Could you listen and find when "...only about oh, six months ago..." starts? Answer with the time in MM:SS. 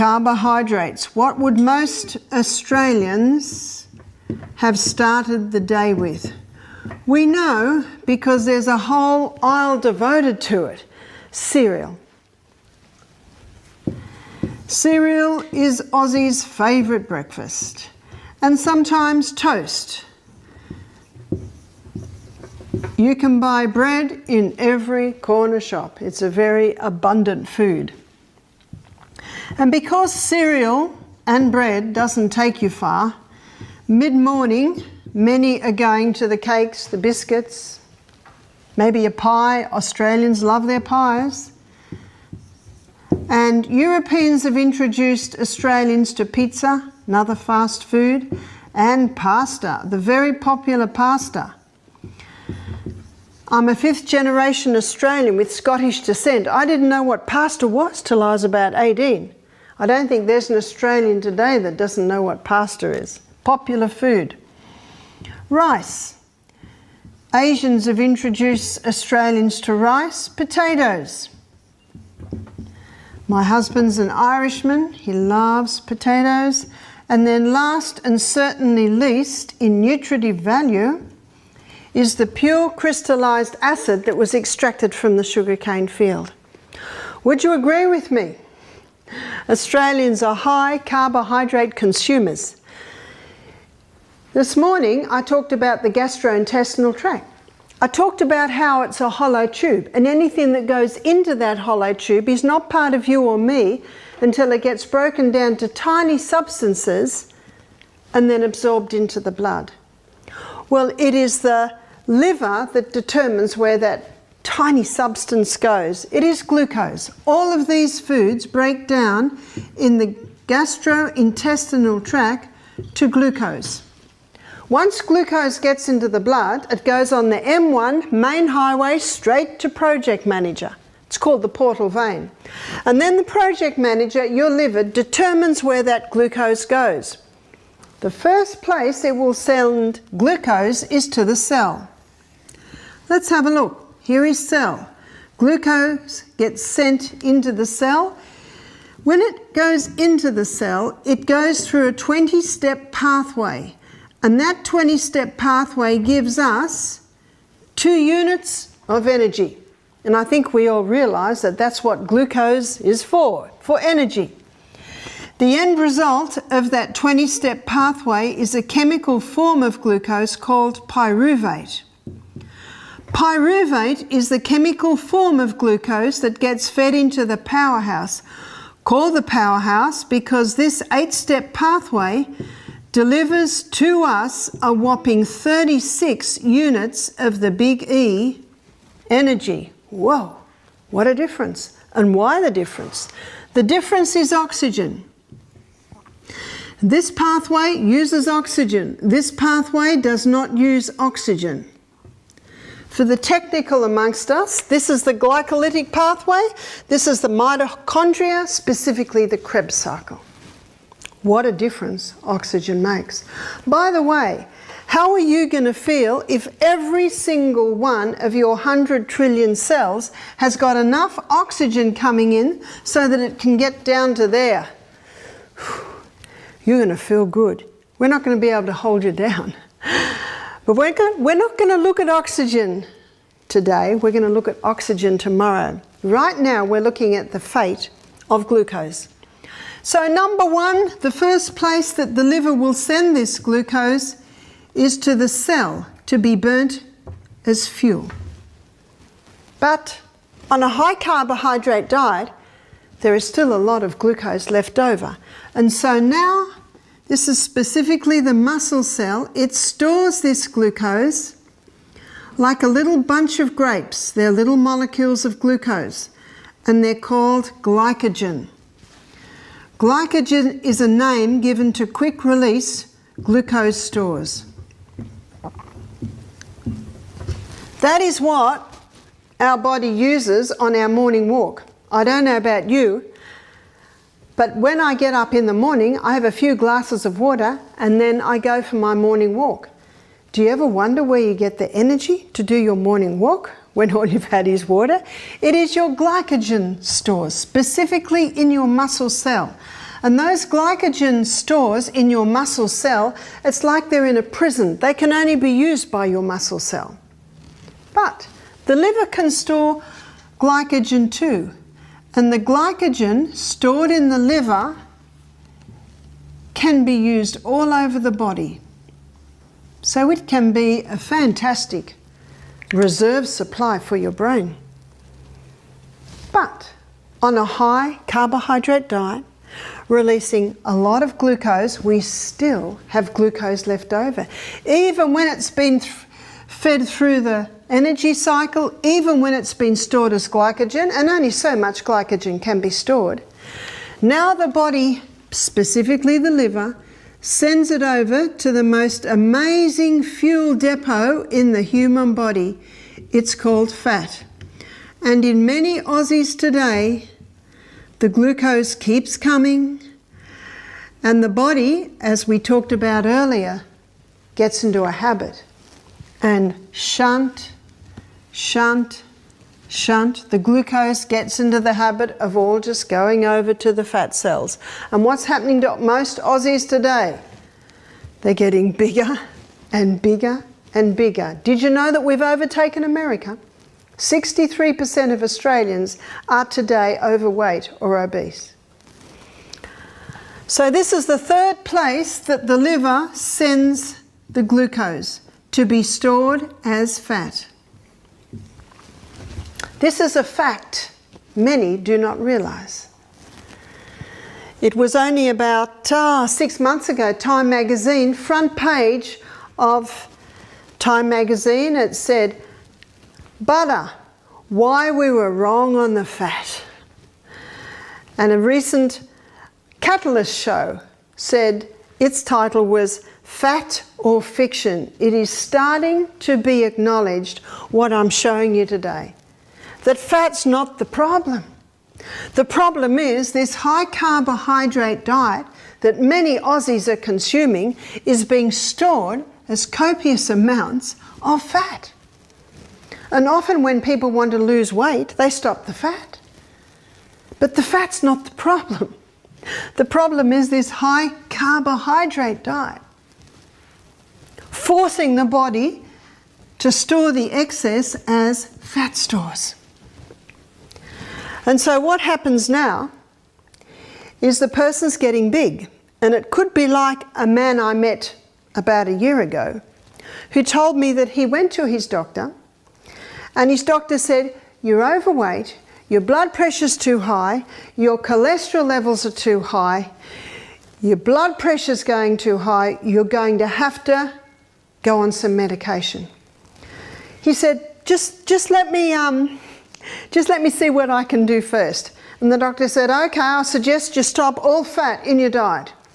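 06:44.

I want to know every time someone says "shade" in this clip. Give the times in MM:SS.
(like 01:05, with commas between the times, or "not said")
not said.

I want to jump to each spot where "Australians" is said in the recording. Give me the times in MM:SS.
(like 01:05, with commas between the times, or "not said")
00:02, 00:39, 00:45, 00:54, 01:00, 01:08, 01:29, 06:25.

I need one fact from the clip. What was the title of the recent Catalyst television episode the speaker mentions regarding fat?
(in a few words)
Fat or Fiction.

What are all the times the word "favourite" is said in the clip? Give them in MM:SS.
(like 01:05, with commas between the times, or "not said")
00:16.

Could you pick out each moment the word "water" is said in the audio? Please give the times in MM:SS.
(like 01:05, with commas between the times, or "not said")
04:47, 04:54.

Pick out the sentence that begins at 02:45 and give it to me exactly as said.
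The end result of that 20 step pathway is a chemical form of glucose called pyruvate.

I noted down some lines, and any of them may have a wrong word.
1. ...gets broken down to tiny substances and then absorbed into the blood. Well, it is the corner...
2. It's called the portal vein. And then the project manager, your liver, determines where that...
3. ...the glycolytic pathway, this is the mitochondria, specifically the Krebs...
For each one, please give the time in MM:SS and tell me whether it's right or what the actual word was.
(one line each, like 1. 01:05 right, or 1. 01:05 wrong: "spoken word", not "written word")
1. 01:44 wrong: "liver", not "corner"
2. 02:11 right
3. 03:25 right.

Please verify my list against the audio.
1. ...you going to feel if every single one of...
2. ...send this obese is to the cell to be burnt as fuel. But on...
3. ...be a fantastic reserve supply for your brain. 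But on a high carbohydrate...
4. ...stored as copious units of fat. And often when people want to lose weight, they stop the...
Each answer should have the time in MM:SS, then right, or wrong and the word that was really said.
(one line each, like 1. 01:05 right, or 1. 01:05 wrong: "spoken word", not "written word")
1. 03:35 right
2. 04:02 wrong: "glucose", not "obese"
3. 05:20 right
4. 07:18 wrong: "amounts", not "units".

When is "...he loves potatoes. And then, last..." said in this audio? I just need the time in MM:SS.
01:14.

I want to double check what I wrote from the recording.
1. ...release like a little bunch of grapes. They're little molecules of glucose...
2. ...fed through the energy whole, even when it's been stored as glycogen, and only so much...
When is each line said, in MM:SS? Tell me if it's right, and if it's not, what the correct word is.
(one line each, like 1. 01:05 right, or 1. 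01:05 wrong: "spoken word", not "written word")
1. 04:20 wrong: "glucose", not "release"
2. 05:36 wrong: "cycle", not "whole".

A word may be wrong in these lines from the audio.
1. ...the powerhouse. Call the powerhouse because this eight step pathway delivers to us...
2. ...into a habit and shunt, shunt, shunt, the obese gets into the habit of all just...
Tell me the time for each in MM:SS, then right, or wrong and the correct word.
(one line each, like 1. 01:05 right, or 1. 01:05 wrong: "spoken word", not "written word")
1. 02:57 right
2. 06:04 wrong: "glucose", not "obese".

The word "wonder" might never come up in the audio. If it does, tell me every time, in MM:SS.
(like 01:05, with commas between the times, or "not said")
04:50.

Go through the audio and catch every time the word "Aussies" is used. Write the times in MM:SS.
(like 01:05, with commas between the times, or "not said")
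00:15, 05:55, 06:16, 07:16.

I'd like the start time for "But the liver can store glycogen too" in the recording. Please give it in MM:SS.
05:07.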